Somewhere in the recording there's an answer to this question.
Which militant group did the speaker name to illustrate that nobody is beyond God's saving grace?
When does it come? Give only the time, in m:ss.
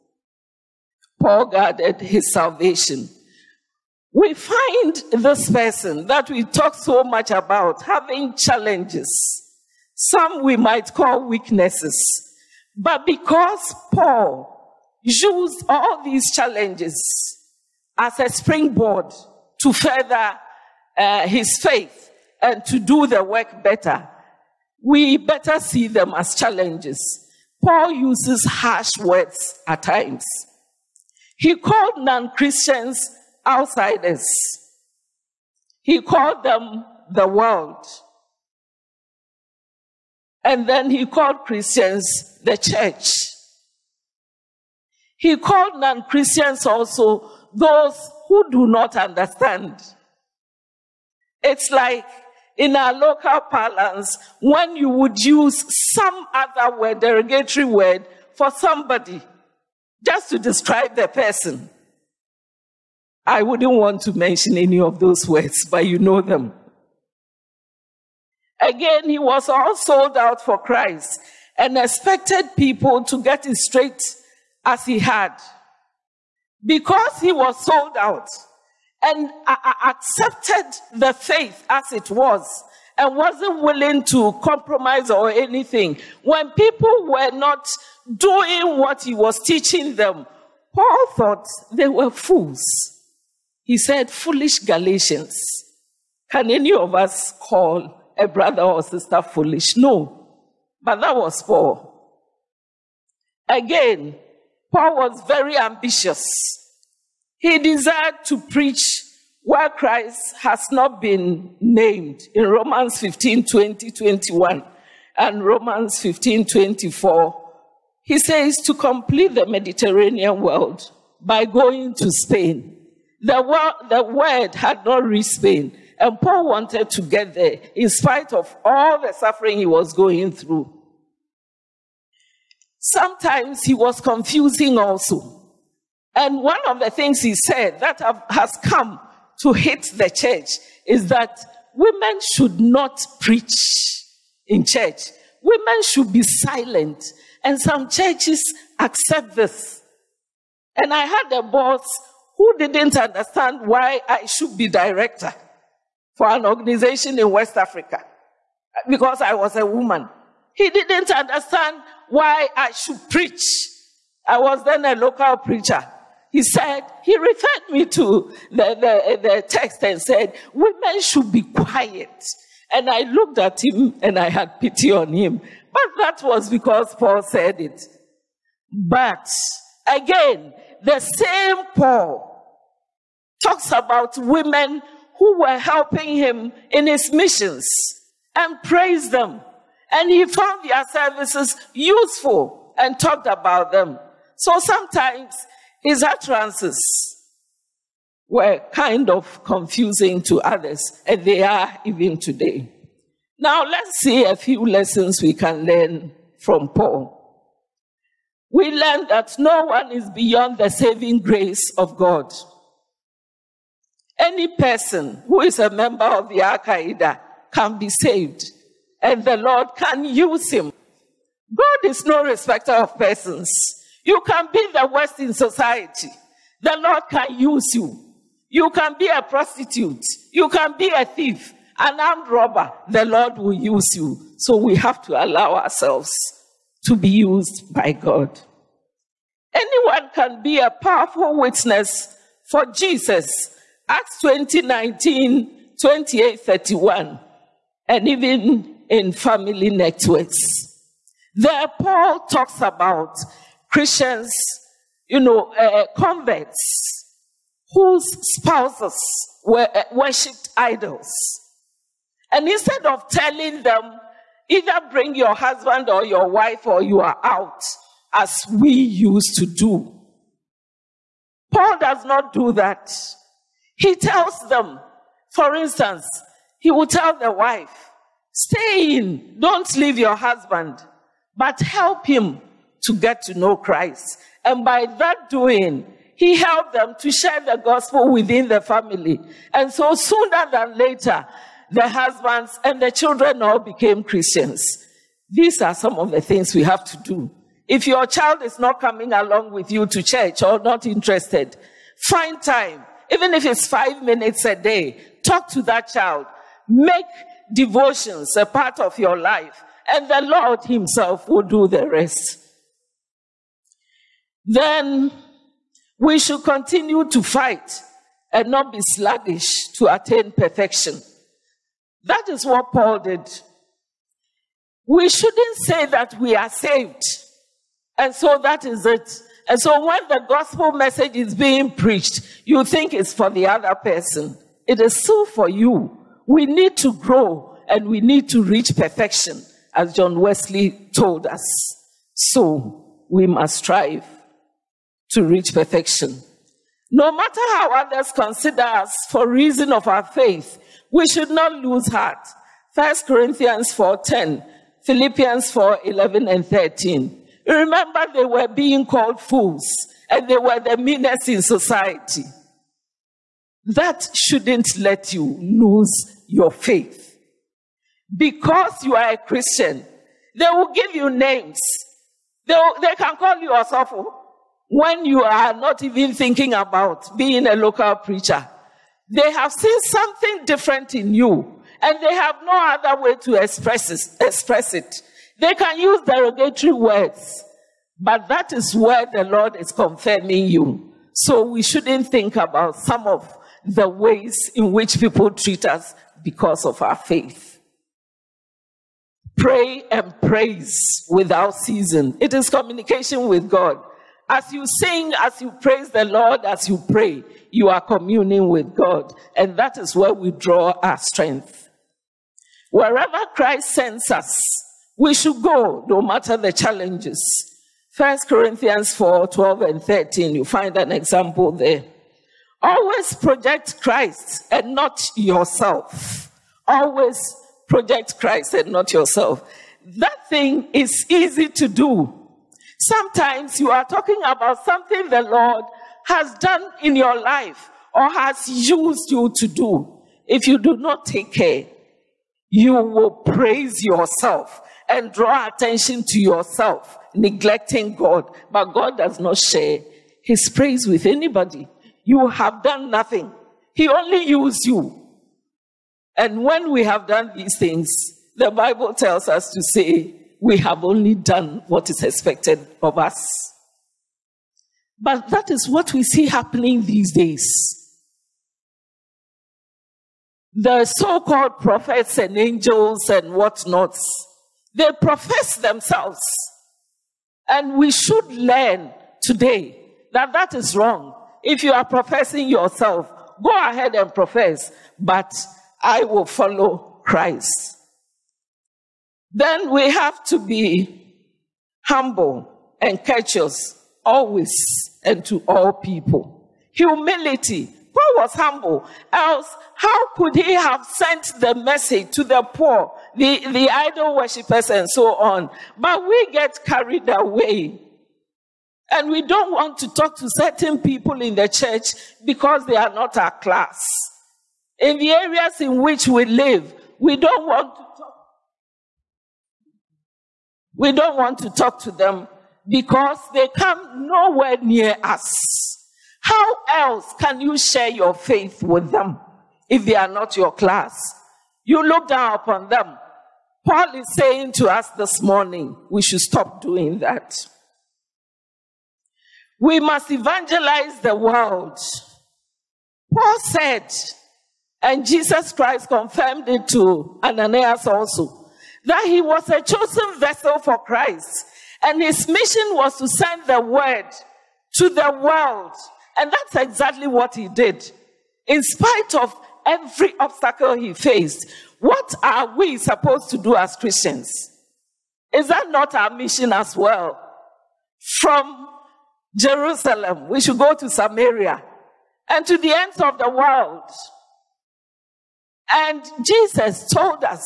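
3:36.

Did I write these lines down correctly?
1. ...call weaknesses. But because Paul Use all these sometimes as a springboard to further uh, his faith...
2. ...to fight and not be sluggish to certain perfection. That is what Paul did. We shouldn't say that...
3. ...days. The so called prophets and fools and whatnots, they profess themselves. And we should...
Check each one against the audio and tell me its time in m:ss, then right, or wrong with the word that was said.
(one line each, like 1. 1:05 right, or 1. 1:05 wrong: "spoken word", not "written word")
1. 0:10 wrong: "challenges", not "sometimes"
2. 5:17 wrong: "attain", not "certain"
3. 7:47 wrong: "angels", not "fools".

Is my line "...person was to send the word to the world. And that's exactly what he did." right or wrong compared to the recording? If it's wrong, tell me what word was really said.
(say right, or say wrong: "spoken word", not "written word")
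wrong: "mission", not "person".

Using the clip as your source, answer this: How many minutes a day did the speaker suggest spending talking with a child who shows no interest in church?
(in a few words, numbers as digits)
5.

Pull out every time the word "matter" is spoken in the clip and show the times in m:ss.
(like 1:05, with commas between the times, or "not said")
5:47, 6:56.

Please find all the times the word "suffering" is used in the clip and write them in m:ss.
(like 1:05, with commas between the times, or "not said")
2:09.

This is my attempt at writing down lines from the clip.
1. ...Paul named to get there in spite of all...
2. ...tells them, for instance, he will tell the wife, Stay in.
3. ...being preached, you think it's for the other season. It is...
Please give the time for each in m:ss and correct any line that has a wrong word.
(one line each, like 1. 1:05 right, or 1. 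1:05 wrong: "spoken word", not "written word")
1. 2:06 wrong: "wanted", not "named"
2. 4:33 right
3. 5:31 wrong: "person", not "season".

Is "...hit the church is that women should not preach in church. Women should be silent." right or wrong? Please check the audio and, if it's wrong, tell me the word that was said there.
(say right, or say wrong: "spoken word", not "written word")
right.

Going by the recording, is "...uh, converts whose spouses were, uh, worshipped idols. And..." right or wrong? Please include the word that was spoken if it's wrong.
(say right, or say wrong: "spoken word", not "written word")
right.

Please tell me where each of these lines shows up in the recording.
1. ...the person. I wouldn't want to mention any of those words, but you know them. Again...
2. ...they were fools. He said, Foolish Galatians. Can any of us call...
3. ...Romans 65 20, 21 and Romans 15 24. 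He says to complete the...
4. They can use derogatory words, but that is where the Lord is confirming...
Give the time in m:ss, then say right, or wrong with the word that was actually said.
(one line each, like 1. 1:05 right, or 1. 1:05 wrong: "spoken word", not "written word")
1. 1:00 right
2. 1:31 right
3. 1:52 wrong: "15", not "65"
4. 6:25 right.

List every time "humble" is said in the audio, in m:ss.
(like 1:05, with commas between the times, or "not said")
8:11, 8:18.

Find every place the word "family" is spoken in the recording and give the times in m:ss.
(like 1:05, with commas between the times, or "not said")
4:09, 4:48.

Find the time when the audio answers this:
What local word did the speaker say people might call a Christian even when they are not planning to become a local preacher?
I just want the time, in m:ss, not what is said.
6:13.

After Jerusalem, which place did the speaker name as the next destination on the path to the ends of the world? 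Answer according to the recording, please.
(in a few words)
Samaria.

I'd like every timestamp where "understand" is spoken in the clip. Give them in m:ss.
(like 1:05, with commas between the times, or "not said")
0:48, 2:32, 2:41.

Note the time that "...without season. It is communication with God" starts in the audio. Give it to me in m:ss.
6:41.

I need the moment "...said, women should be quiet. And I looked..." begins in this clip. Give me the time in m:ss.
2:50.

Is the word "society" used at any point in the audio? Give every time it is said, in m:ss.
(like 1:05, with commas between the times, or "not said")
3:45, 6:01.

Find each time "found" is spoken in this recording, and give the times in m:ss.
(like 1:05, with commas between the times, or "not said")
3:10.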